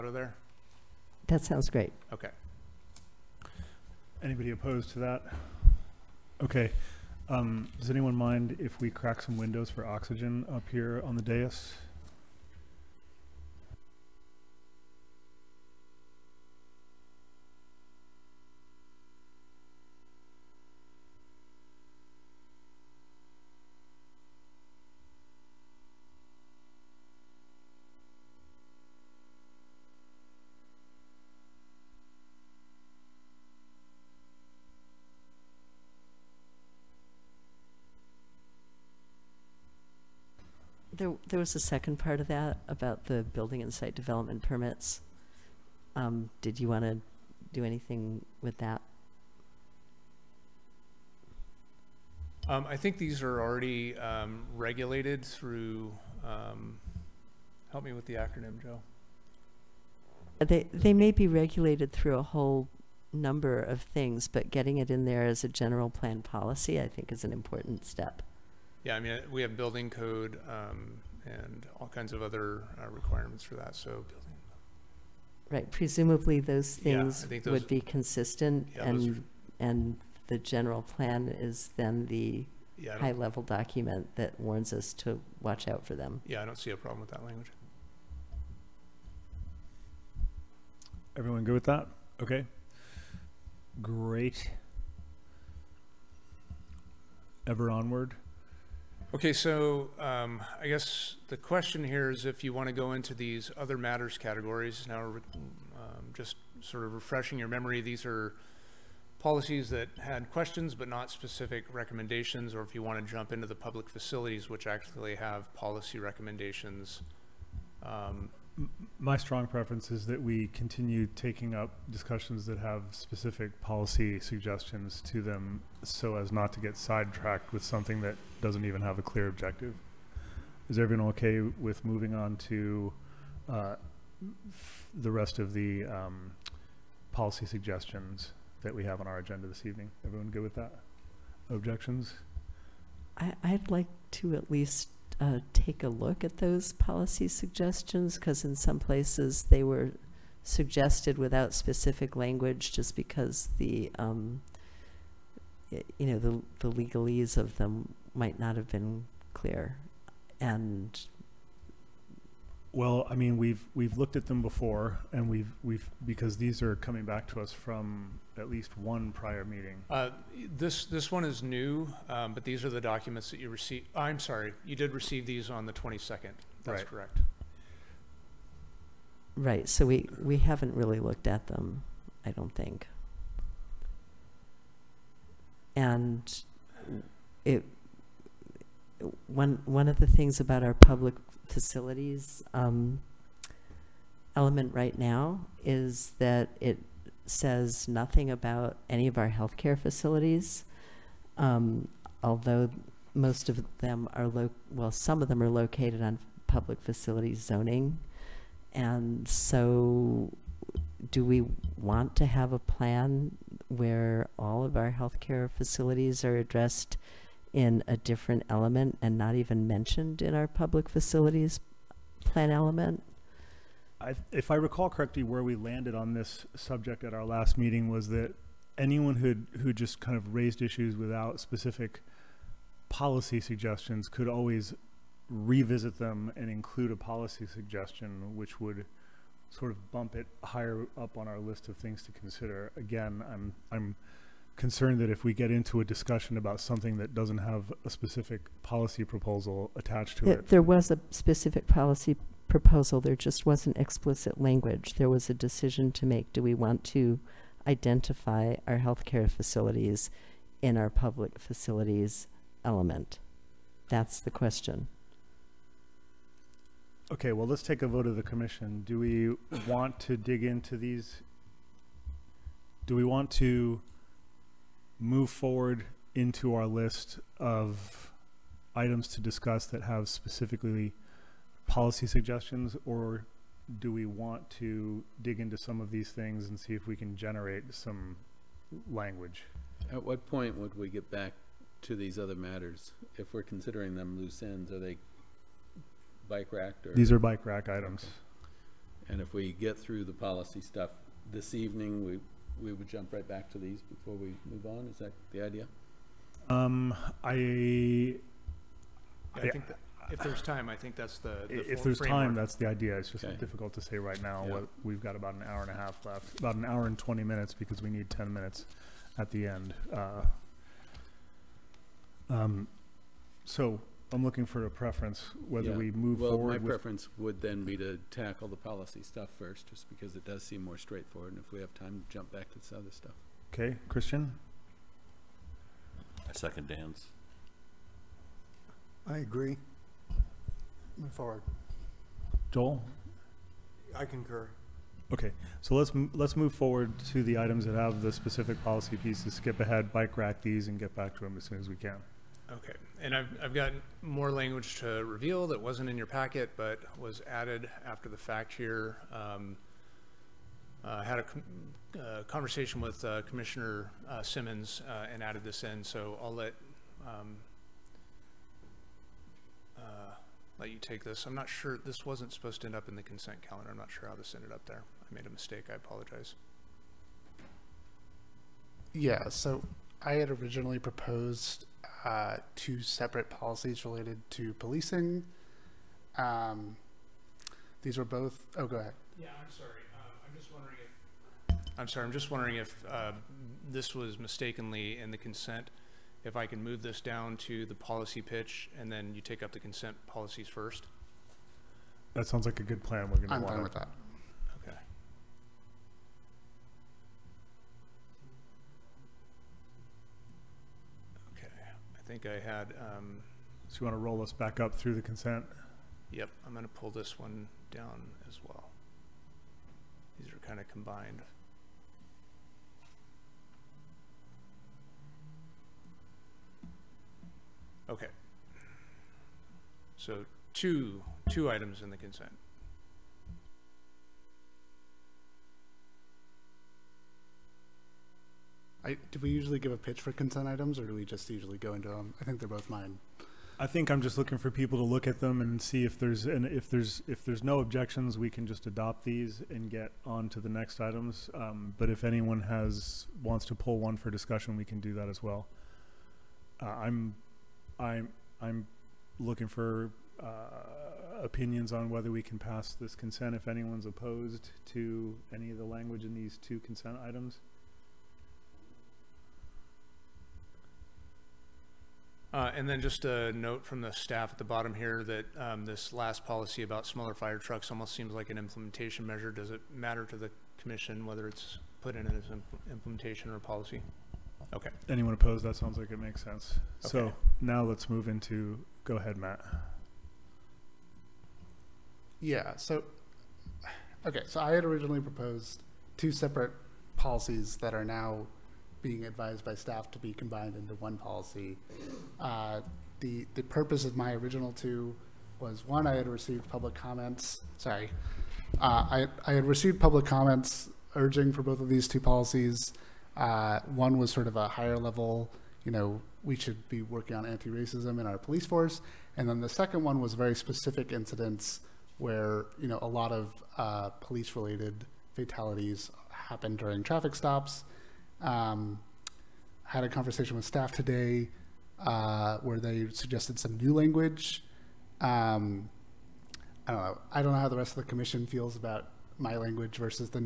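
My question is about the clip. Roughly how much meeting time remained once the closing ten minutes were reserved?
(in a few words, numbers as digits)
An hour and twenty minutes.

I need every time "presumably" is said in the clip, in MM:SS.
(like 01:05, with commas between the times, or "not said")
01:15.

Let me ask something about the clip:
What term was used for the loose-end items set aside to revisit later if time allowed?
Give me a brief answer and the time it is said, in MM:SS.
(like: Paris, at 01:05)
Bike rack items, at 04:57.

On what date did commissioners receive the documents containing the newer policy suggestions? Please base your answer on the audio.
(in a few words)
the 22nd.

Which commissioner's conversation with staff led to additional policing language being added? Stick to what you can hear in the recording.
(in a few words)
Simmons.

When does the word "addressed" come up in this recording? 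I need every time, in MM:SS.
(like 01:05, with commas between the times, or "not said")
03:36.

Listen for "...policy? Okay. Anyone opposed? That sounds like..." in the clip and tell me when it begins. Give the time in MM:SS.
08:03.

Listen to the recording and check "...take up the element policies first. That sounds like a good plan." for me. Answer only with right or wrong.
wrong.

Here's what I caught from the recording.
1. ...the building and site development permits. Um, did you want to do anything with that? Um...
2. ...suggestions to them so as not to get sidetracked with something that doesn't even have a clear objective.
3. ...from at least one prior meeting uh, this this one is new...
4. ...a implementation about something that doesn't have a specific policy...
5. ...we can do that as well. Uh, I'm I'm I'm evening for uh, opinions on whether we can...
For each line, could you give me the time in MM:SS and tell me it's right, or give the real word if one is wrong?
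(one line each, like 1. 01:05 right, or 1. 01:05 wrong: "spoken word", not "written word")
1. 00:43 right
2. 02:04 right
3. 02:47 right
4. 04:05 wrong: "discussion", not "implementation"
5. 07:34 wrong: "looking", not "evening".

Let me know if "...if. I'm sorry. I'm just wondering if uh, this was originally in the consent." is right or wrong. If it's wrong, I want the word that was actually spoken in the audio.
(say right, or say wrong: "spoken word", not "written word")
wrong: "mistakenly", not "originally".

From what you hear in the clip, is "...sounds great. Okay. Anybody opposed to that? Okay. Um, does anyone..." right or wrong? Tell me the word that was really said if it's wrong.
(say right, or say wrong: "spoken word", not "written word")
right.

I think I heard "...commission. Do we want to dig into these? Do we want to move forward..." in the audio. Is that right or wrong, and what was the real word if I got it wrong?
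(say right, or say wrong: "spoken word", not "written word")
right.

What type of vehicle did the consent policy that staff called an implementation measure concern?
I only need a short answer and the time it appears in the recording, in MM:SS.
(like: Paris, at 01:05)
Smaller fire trucks, at 07:56.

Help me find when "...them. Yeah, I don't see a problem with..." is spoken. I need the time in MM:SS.
01:25.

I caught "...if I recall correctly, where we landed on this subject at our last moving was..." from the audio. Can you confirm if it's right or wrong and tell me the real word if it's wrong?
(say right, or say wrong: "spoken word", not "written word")
wrong: "meeting", not "moving".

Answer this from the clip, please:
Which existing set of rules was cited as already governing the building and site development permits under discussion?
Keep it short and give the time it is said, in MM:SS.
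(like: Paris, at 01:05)
Building code, at 01:09.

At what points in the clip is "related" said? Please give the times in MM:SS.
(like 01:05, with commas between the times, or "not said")
06:23, 08:44.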